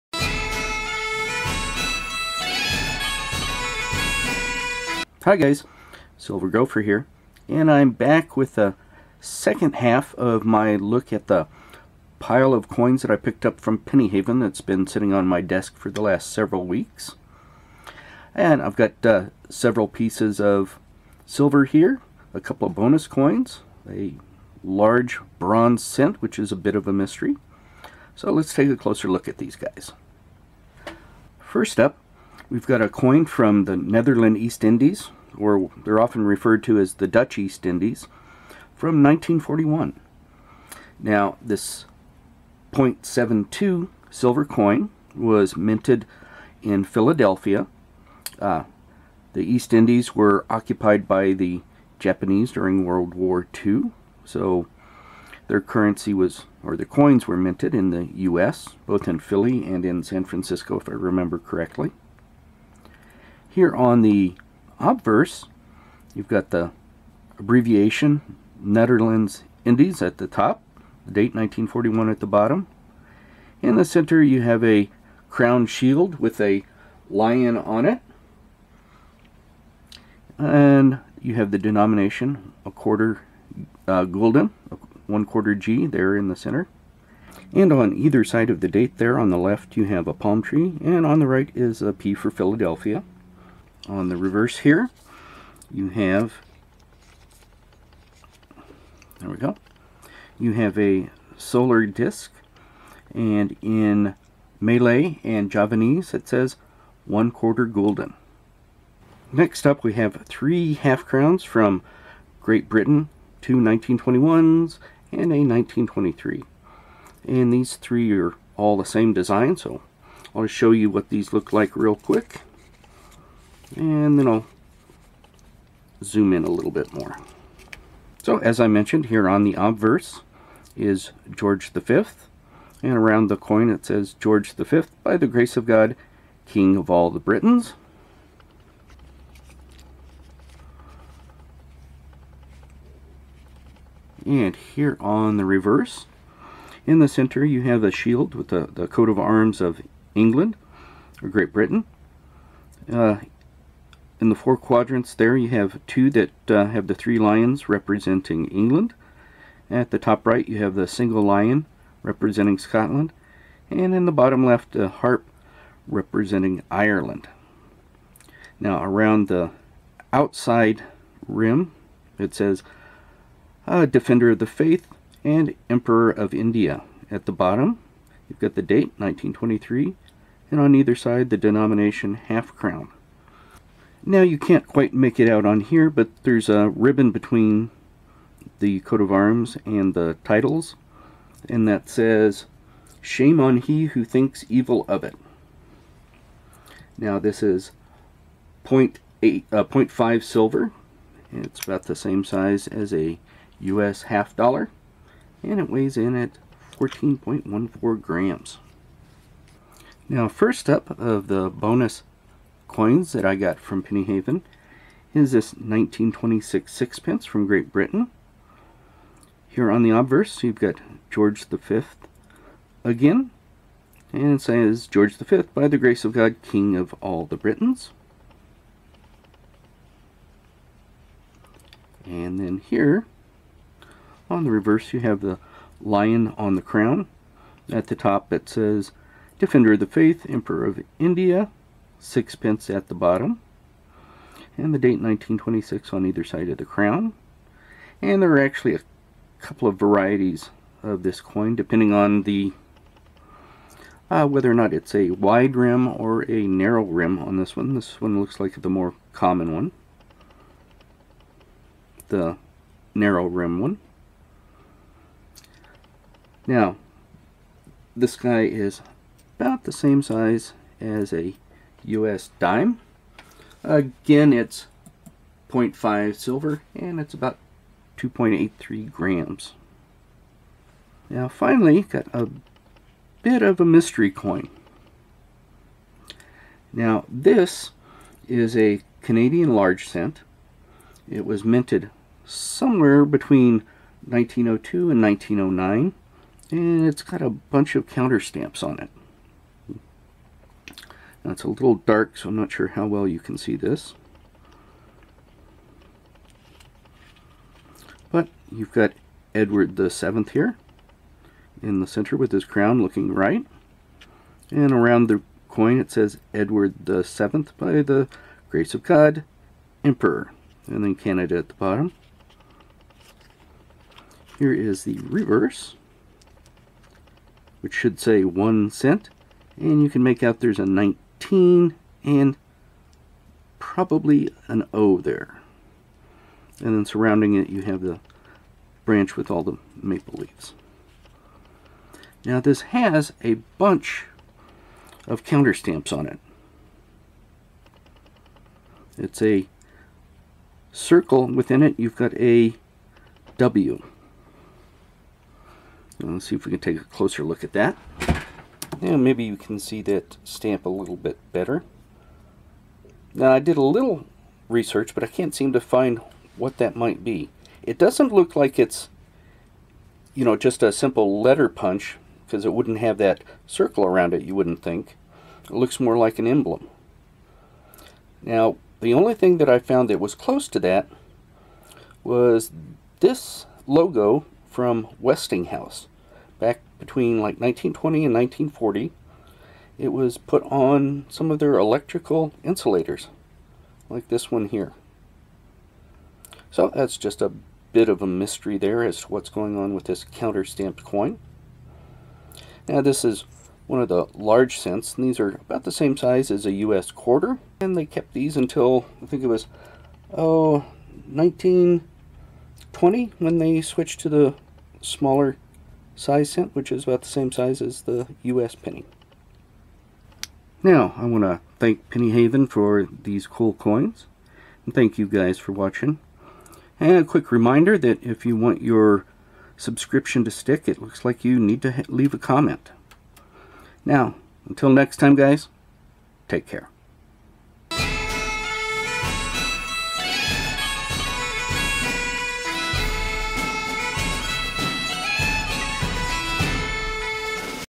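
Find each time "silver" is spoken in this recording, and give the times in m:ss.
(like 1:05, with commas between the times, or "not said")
0:06, 0:21, 0:44, 3:20, 4:36.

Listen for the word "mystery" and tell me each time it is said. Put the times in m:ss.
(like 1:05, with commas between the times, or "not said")
0:26, 4:43, 6:38.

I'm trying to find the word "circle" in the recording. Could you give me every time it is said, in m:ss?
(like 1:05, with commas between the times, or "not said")
5:50, 6:13.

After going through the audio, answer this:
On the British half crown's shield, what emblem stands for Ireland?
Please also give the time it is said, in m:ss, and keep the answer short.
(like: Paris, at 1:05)
A harp, at 2:44.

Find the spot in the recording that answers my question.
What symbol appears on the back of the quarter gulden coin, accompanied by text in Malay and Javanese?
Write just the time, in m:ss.
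1:41.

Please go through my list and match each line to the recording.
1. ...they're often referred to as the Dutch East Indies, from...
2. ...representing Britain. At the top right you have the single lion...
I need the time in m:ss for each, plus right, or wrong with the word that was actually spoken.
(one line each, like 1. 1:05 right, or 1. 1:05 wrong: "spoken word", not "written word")
1. 0:35 right
2. 2:37 wrong: "England", not "Britain".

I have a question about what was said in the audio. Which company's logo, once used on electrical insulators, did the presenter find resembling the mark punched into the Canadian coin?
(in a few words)
Westinghouse.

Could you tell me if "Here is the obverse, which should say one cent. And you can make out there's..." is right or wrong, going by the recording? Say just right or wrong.
wrong.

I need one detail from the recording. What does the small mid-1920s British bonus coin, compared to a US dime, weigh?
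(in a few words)
2.83 grams.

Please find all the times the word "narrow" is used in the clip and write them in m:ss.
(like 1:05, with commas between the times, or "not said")
4:16, 4:22.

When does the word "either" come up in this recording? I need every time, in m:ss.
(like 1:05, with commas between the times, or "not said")
1:27, 3:00, 4:06.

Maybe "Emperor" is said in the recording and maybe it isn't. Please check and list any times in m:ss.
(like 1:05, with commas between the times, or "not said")
2:55, 4:00, 5:19.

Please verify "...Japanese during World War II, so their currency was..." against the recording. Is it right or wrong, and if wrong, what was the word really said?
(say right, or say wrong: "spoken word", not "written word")
right.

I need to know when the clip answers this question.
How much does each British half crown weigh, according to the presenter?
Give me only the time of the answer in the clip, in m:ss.
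3:26.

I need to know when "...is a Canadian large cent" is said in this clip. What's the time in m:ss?
4:48.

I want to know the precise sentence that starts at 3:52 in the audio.
And then here, on the reverse, you have the lion on the crown.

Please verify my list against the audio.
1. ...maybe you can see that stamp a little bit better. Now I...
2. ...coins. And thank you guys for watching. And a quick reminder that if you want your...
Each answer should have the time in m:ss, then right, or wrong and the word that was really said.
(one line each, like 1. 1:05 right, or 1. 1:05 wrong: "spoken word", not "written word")
1. 5:58 right
2. 7:03 right.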